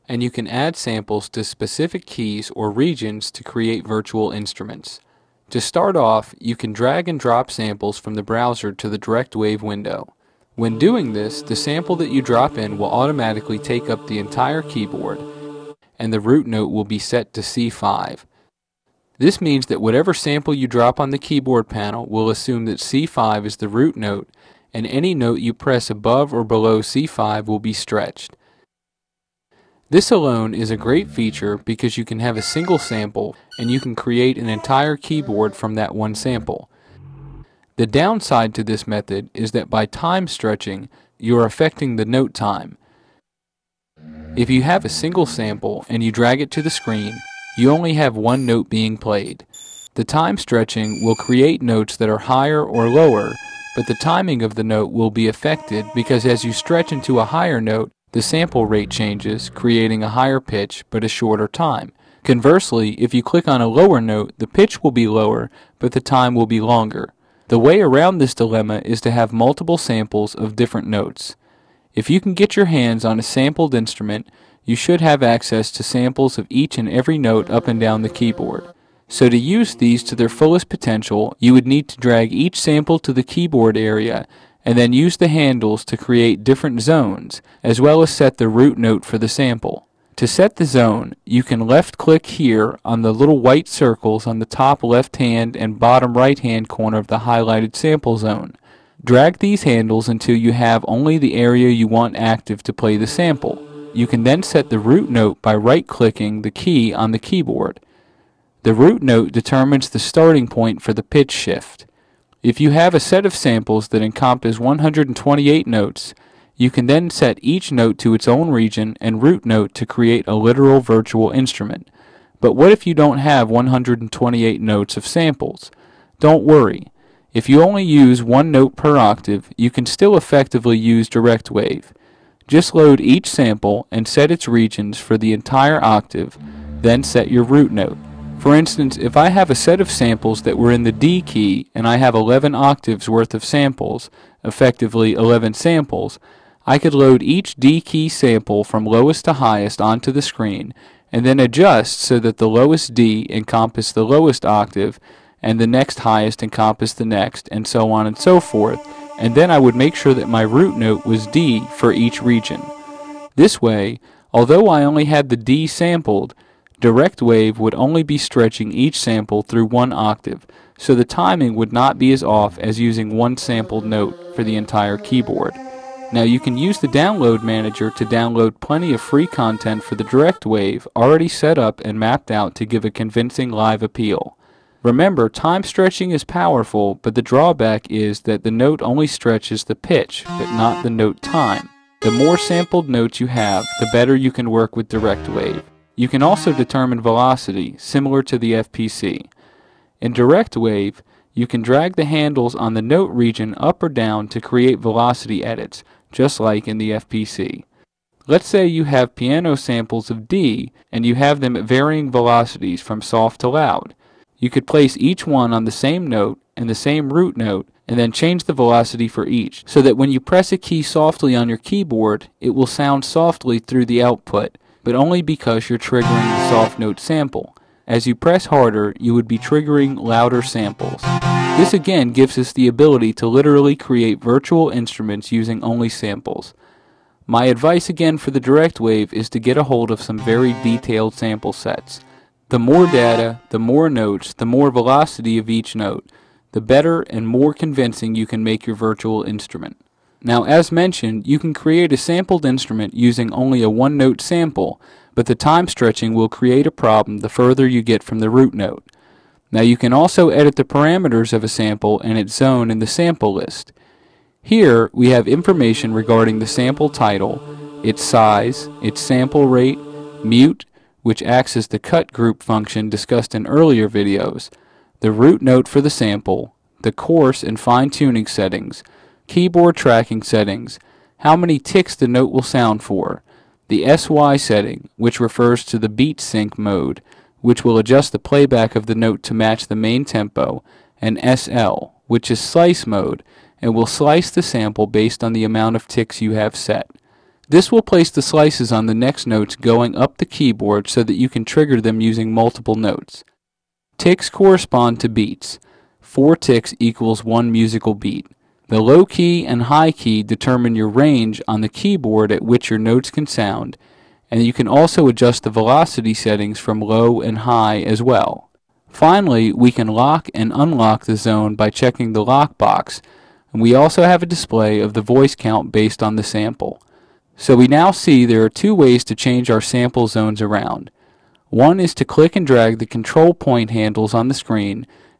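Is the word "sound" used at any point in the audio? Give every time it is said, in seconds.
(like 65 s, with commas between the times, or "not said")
222 s, 282 s, 313 s.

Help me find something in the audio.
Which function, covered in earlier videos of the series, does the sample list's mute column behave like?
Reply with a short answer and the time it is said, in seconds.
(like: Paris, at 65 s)
cut group, at 271 s.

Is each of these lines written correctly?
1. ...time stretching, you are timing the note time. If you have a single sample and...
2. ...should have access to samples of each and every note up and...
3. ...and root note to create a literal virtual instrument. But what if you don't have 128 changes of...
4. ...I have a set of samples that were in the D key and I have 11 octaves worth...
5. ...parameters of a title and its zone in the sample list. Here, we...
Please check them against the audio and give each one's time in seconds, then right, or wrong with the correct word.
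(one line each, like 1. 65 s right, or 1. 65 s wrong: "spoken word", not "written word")
1. 39 s wrong: "affecting", not "timing"
2. 74 s right
3. 119 s wrong: "notes", not "changes"
4. 139 s right
5. 260 s wrong: "sample", not "title".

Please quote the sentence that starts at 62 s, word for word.
Conversely, if you click on a lower note, the pitch will be lower, but the time will be longer.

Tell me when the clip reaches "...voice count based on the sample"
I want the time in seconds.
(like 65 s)
325 s.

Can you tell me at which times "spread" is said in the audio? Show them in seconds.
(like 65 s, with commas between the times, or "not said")
not said.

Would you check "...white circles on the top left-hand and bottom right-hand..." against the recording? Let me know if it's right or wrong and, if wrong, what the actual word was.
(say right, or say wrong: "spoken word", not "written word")
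right.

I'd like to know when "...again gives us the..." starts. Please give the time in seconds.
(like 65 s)
231 s.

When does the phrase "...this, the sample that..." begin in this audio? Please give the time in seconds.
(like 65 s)
11 s.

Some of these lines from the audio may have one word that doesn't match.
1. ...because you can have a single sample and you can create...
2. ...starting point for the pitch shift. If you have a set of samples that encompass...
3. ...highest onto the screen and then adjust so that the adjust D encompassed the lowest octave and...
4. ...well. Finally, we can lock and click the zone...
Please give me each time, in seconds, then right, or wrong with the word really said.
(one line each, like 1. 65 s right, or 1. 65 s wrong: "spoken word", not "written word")
1. 31 s right
2. 110 s right
3. 149 s wrong: "lowest", not "adjust"
4. 318 s wrong: "unlock", not "click".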